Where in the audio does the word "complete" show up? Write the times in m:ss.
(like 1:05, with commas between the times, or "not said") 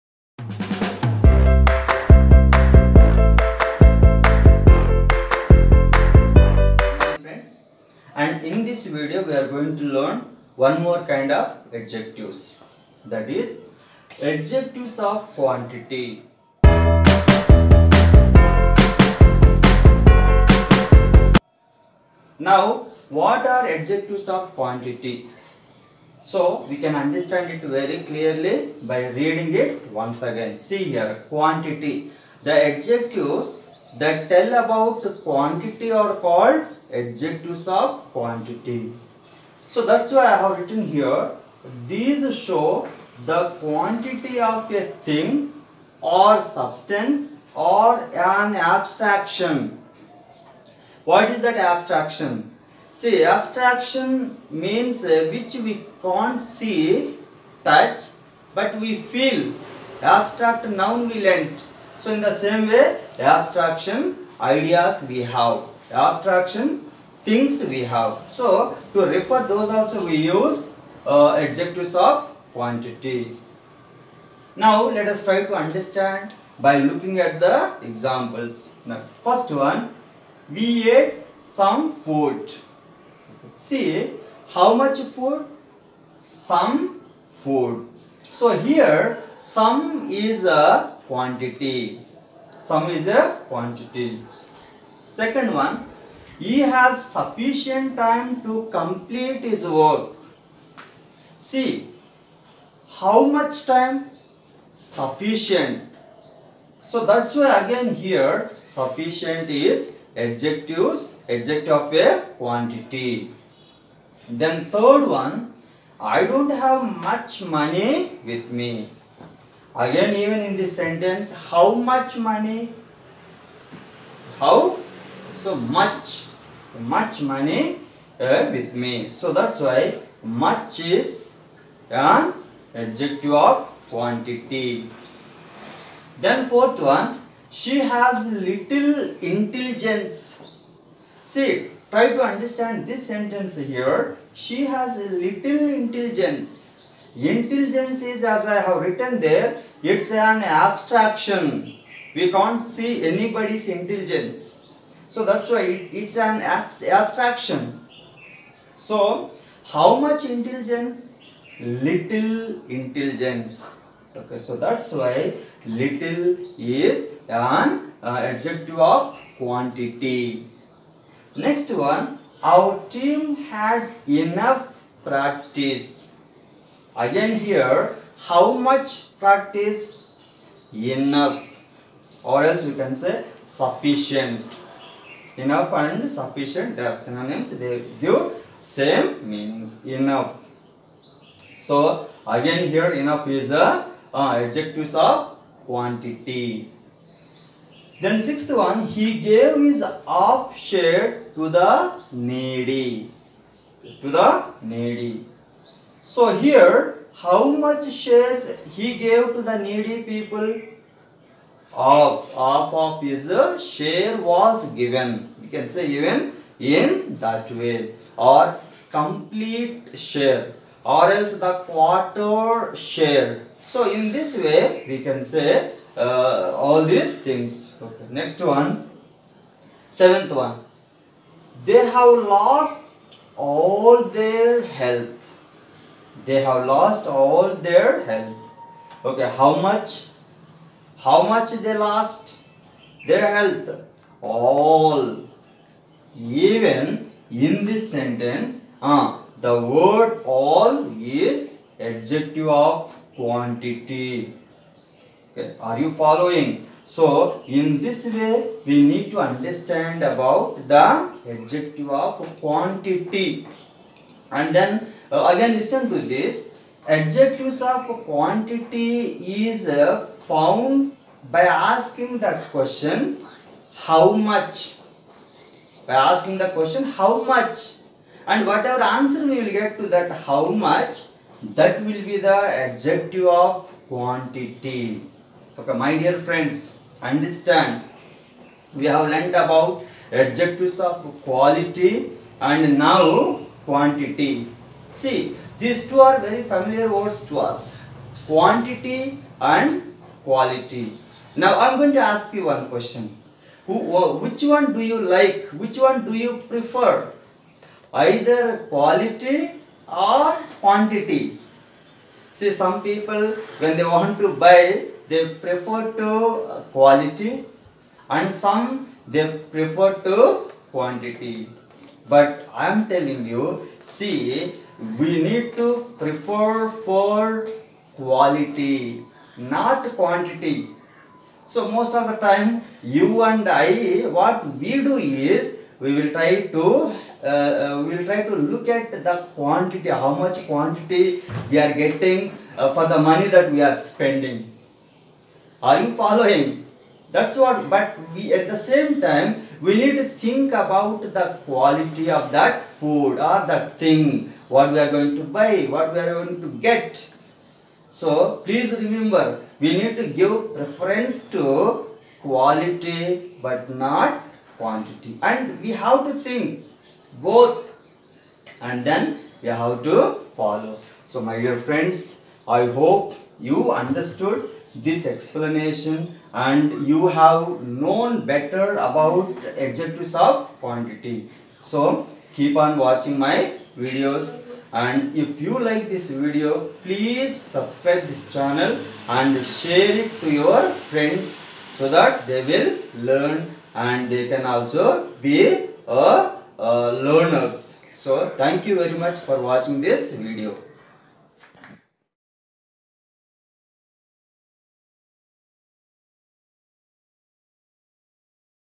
1:38, 3:38.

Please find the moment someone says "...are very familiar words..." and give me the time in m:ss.
4:56.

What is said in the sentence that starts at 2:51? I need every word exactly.
Next one, our team had enough practice Again here, how much practice?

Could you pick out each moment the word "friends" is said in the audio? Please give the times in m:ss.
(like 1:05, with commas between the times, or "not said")
4:46, 6:11, 6:30.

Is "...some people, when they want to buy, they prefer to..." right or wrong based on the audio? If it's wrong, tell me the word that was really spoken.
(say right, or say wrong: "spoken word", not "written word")
right.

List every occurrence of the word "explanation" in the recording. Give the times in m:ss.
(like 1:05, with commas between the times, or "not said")
6:15.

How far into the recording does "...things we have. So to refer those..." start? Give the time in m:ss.
1:07.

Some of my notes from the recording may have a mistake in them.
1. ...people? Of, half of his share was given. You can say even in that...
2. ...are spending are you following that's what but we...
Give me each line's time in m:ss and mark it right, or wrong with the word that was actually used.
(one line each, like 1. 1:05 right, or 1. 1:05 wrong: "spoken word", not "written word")
1. 3:30 right
2. 5:43 right.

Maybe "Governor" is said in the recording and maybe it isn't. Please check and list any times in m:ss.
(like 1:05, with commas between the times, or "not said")
not said.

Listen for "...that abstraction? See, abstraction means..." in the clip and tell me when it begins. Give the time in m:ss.
0:51.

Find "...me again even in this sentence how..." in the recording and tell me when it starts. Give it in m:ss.
1:58.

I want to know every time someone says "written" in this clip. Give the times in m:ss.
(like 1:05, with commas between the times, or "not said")
0:40, 2:28.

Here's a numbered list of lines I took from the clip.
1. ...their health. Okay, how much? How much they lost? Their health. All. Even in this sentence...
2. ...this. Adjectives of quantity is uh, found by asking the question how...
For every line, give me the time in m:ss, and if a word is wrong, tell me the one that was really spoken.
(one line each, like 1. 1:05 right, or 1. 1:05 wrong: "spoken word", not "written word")
1. 3:57 right
2. 4:26 right.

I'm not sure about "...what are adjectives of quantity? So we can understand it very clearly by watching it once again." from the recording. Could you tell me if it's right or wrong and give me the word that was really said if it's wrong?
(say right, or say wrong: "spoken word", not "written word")
wrong: "reading", not "watching".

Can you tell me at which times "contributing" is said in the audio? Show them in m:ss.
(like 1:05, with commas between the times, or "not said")
not said.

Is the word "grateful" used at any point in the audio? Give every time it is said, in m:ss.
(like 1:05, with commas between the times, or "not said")
not said.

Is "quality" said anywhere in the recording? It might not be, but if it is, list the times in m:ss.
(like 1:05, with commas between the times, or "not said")
4:51, 5:00, 5:08, 5:16, 5:27, 5:51, 6:02.